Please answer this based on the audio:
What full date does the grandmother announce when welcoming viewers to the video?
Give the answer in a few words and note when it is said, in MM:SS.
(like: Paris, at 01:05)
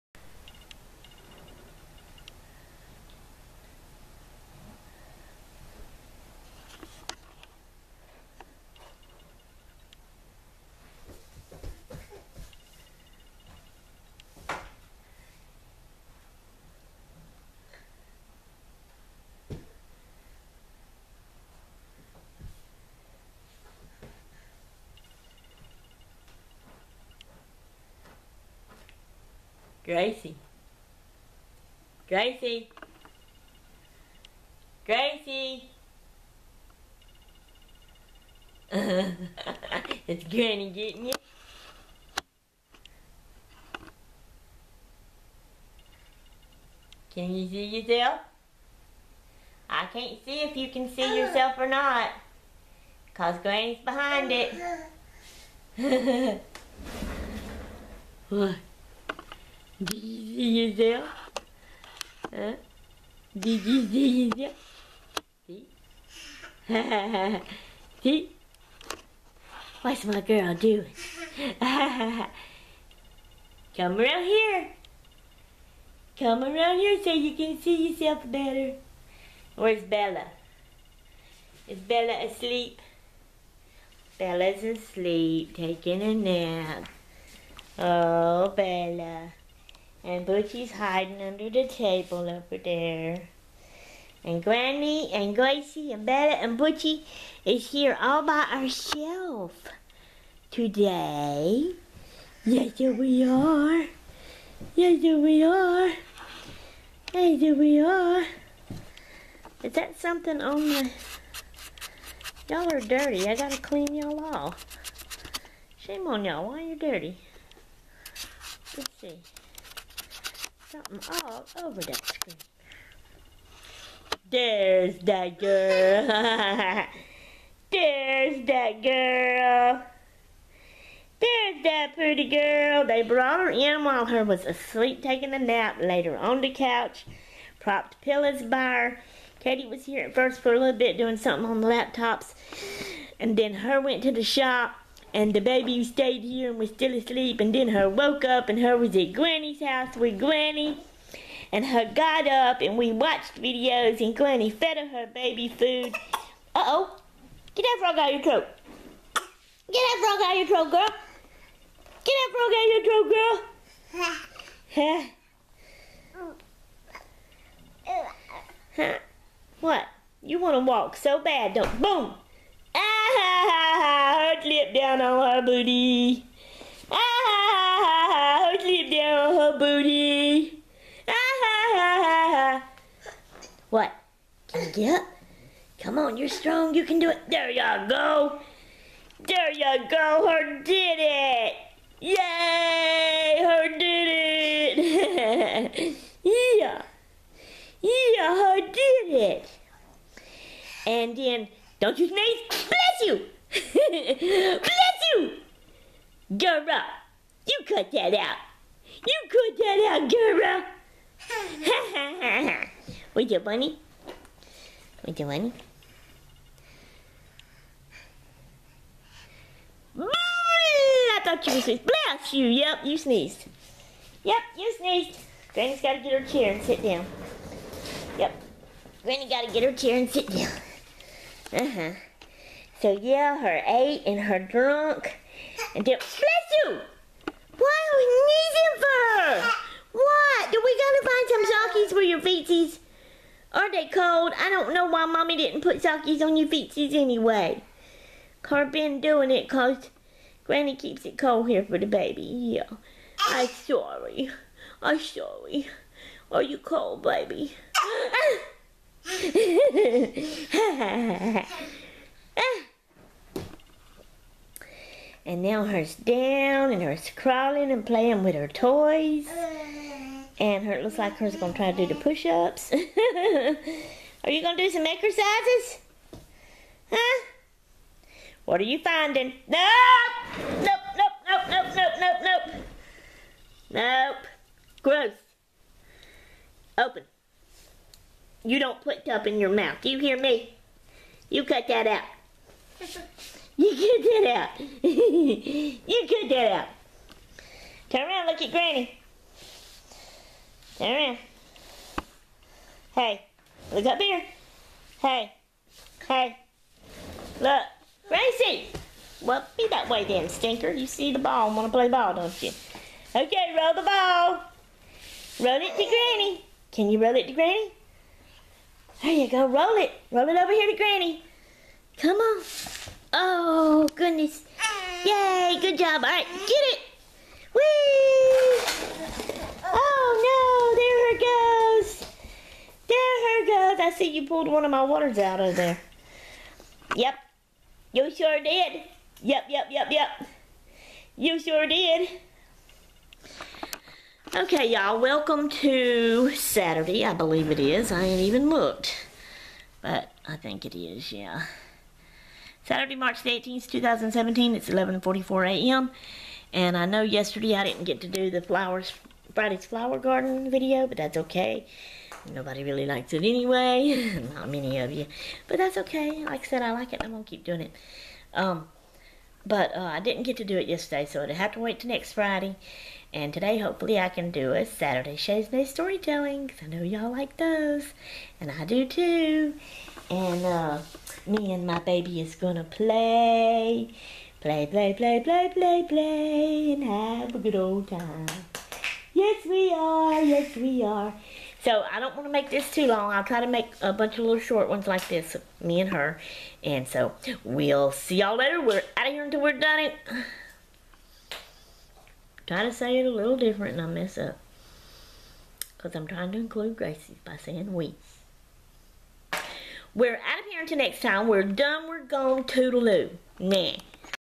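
March 18, 2017, at 05:52.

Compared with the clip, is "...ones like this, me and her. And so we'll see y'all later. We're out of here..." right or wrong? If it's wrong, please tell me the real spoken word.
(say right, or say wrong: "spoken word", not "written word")
right.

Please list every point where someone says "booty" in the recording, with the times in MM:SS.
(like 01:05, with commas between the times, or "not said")
02:55, 02:59.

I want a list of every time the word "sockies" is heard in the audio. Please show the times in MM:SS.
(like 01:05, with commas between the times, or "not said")
04:01, 04:05.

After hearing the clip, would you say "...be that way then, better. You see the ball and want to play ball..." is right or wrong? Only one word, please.
wrong.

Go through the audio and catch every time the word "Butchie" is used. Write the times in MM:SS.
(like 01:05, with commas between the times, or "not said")
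01:30, 01:36.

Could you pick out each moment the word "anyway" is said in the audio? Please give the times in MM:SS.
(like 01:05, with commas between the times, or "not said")
04:06, 06:03.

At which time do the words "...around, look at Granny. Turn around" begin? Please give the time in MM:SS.
04:58.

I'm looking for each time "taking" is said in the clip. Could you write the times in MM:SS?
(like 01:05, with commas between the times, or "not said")
01:25, 02:15.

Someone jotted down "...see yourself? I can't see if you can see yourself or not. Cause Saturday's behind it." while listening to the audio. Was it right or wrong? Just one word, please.
wrong.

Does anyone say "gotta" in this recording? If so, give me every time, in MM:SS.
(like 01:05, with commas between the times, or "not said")
01:53, 04:00.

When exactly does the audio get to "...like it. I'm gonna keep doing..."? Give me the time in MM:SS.
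06:06.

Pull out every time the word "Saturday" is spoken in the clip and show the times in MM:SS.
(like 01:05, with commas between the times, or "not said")
05:46, 05:52, 06:14.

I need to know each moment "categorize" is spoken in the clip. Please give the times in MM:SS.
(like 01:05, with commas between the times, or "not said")
not said.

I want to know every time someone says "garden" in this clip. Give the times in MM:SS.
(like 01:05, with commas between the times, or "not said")
05:59.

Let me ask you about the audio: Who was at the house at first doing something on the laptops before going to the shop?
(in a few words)
Katie.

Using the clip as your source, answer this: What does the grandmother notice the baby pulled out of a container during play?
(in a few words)
waters.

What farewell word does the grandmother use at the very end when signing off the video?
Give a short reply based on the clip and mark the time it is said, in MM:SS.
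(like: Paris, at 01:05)
Toodaloo, at 06:52.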